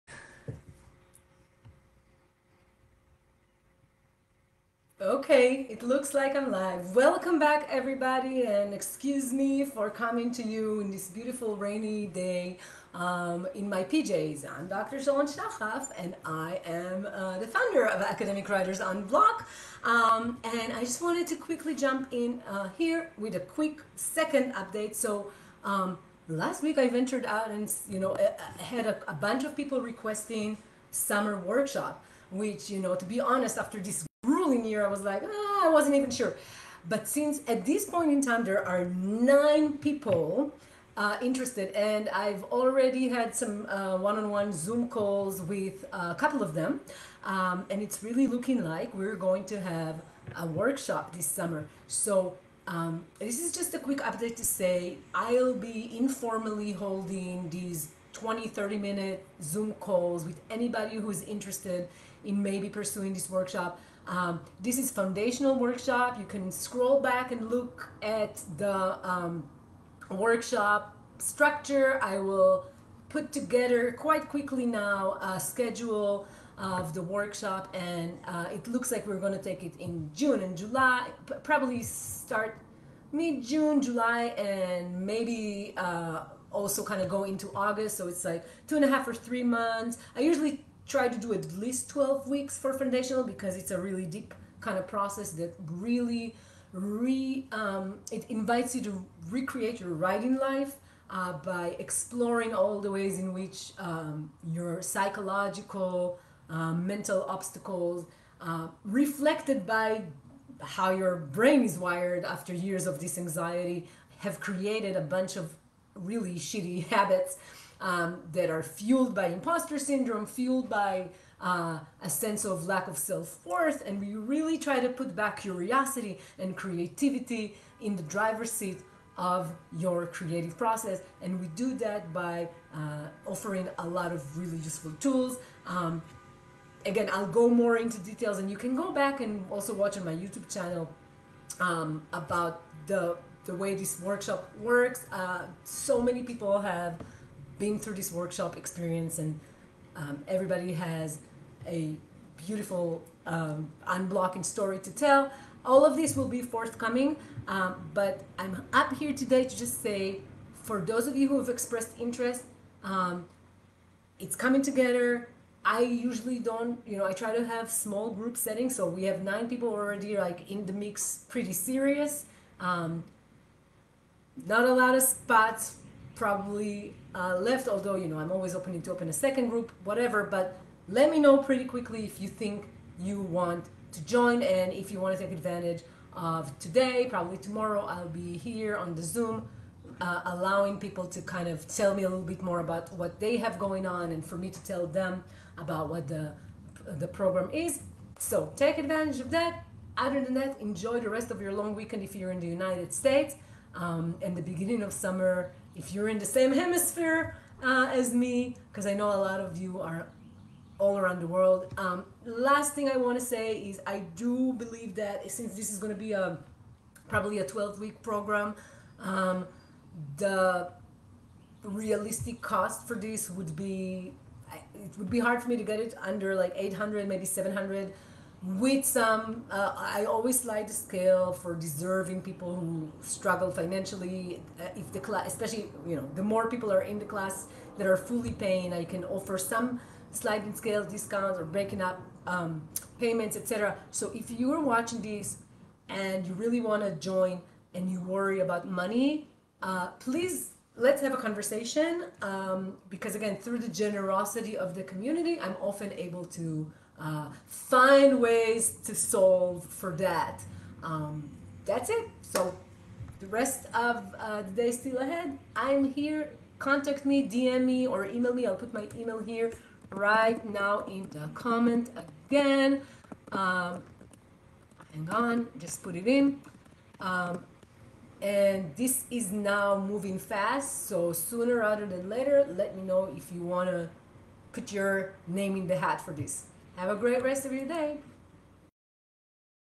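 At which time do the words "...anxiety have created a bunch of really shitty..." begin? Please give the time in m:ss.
1:53.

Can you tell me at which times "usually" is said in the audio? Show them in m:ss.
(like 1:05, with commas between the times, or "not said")
1:30, 2:45.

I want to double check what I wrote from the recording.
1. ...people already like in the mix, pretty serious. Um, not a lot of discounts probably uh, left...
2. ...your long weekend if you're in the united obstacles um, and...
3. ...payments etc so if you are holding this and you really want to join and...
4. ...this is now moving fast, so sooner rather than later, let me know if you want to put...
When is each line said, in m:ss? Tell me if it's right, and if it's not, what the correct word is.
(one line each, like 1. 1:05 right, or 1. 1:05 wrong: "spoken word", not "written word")
1. 2:49 wrong: "spots", not "discounts"
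2. 3:21 wrong: "states", not "obstacles"
3. 4:02 wrong: "watching", not "holding"
4. 4:38 right.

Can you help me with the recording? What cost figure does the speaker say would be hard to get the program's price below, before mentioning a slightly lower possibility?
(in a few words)
800.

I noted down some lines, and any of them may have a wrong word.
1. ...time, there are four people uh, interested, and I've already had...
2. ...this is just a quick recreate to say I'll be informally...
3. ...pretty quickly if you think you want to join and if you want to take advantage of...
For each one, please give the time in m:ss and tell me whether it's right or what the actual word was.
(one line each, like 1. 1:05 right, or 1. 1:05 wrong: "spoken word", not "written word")
1. 0:38 wrong: "nine", not "four"
2. 0:53 wrong: "update", not "recreate"
3. 3:01 right.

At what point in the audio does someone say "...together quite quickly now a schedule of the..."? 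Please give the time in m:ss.
1:13.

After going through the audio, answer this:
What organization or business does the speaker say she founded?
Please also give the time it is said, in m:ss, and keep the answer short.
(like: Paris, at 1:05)
Academic Writers Unblock, at 0:18.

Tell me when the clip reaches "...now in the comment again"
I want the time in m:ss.
4:30.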